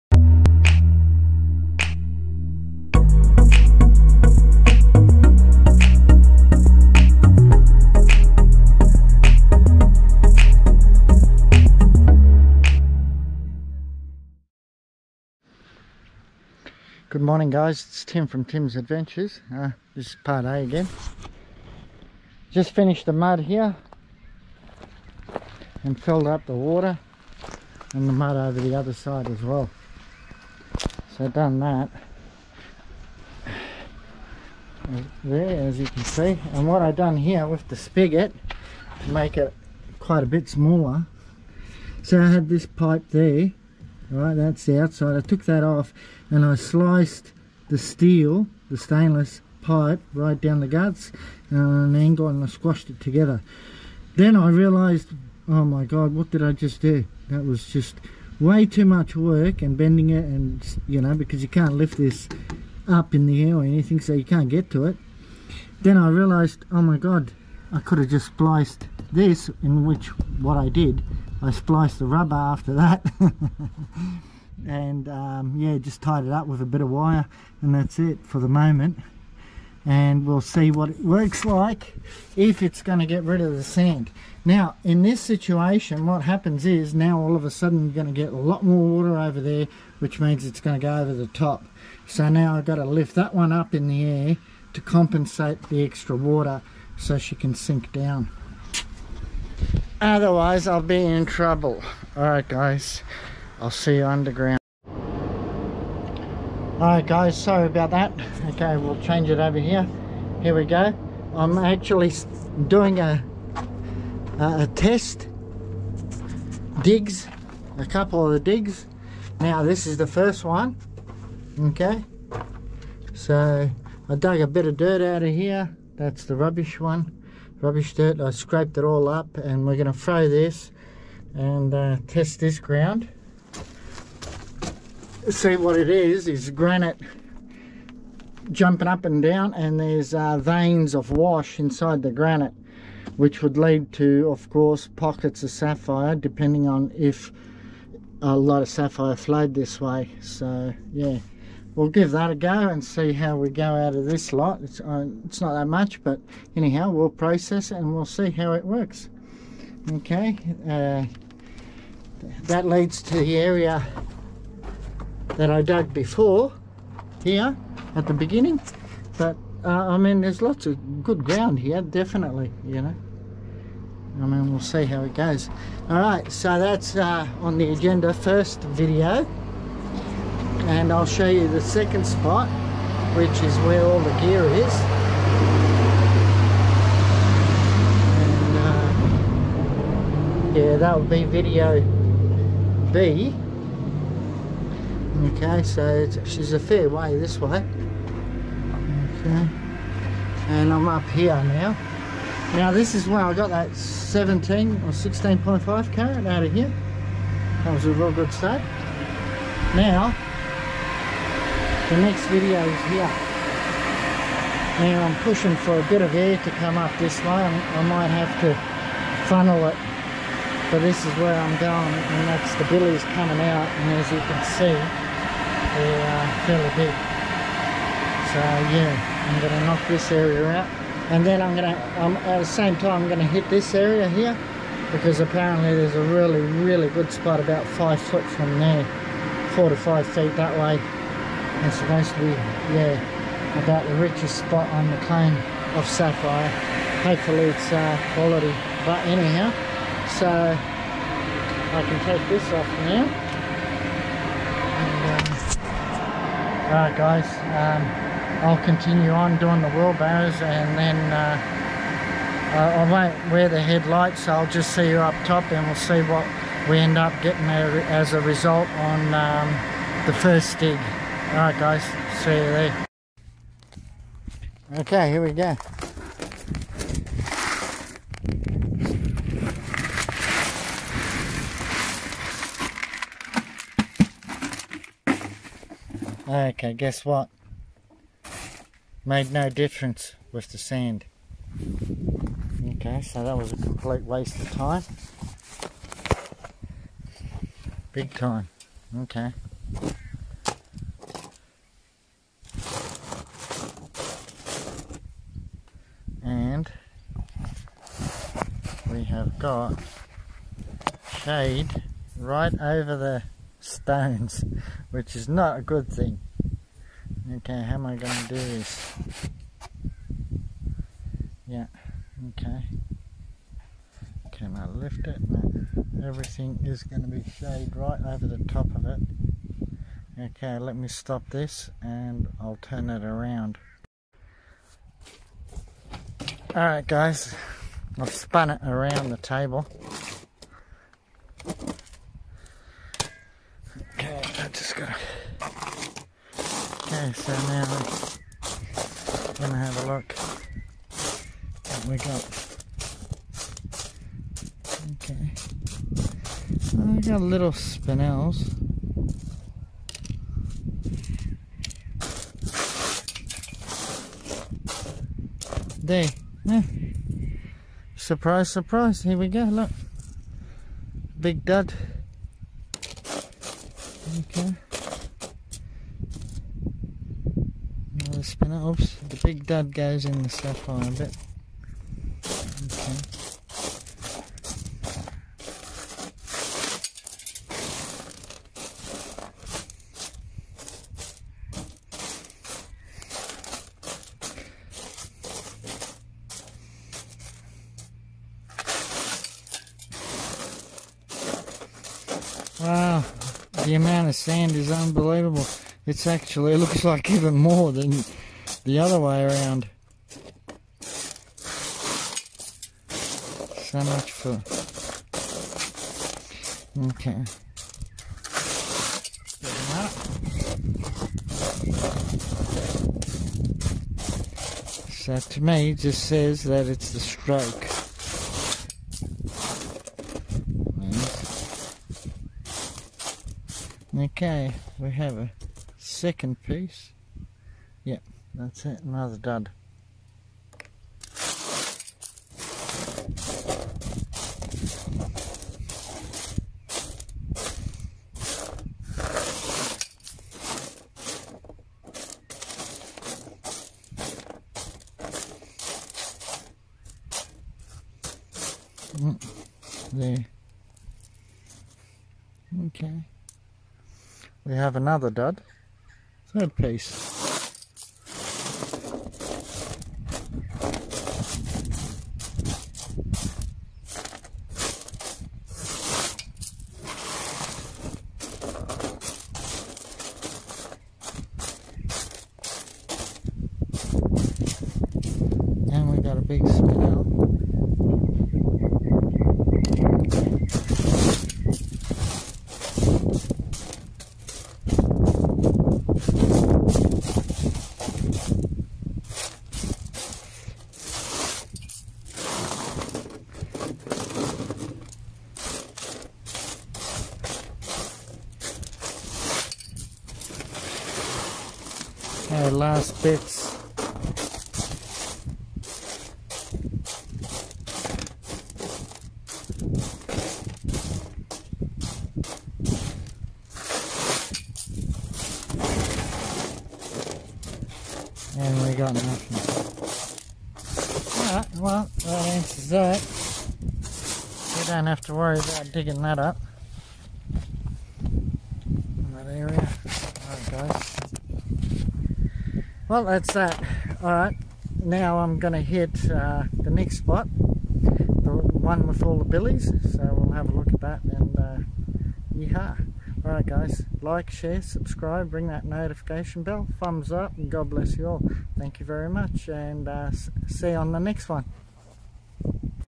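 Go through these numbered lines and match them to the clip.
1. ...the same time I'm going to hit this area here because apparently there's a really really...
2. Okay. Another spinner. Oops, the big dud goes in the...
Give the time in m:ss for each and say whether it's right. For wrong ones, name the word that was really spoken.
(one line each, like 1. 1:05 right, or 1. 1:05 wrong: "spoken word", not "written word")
1. 3:52 right
2. 6:12 right.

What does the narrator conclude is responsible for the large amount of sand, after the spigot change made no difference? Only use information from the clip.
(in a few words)
the stroke.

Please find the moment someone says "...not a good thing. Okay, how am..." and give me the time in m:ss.
5:15.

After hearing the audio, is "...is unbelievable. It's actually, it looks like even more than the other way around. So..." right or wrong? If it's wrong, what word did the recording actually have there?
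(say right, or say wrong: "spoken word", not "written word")
right.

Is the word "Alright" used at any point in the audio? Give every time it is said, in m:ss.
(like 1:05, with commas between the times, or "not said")
1:42, 1:46, 4:16, 4:31, 5:36, 8:51.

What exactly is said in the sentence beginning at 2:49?
But uh, I mean, there's lots of good ground here, definitely, you know.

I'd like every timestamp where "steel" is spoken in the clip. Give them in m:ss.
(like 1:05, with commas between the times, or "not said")
0:47.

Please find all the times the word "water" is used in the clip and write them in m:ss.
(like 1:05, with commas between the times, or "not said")
0:26, 1:29, 1:36.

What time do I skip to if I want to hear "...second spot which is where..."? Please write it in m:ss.
3:01.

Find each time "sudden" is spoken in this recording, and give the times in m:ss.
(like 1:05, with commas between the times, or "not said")
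1:27.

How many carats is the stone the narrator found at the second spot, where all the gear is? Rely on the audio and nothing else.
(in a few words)
16.5 carats.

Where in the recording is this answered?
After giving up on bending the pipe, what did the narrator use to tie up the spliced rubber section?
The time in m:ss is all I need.
1:16.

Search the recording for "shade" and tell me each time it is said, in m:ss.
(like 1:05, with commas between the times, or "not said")
5:11, 5:27.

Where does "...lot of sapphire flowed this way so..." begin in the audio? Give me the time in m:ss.
2:28.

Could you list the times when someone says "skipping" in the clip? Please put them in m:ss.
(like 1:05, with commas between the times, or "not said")
not said.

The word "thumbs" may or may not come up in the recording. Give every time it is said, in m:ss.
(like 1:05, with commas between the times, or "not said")
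9:16.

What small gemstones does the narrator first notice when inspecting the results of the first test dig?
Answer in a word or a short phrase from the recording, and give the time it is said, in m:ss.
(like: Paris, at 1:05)
spinels, at 5:57.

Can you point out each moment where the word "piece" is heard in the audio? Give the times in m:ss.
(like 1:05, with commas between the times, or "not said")
7:16, 7:46.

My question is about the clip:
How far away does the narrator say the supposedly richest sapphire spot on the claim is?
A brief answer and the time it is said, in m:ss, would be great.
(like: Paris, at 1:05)
4 to 5 feet, at 3:59.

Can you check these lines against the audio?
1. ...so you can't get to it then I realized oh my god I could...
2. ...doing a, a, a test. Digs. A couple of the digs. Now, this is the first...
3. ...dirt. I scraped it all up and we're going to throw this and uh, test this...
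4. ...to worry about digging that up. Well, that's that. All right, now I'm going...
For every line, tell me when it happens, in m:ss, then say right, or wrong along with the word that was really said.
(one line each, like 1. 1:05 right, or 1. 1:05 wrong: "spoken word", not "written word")
1. 1:04 right
2. 1:52 right
3. 2:07 right
4. 8:55 right.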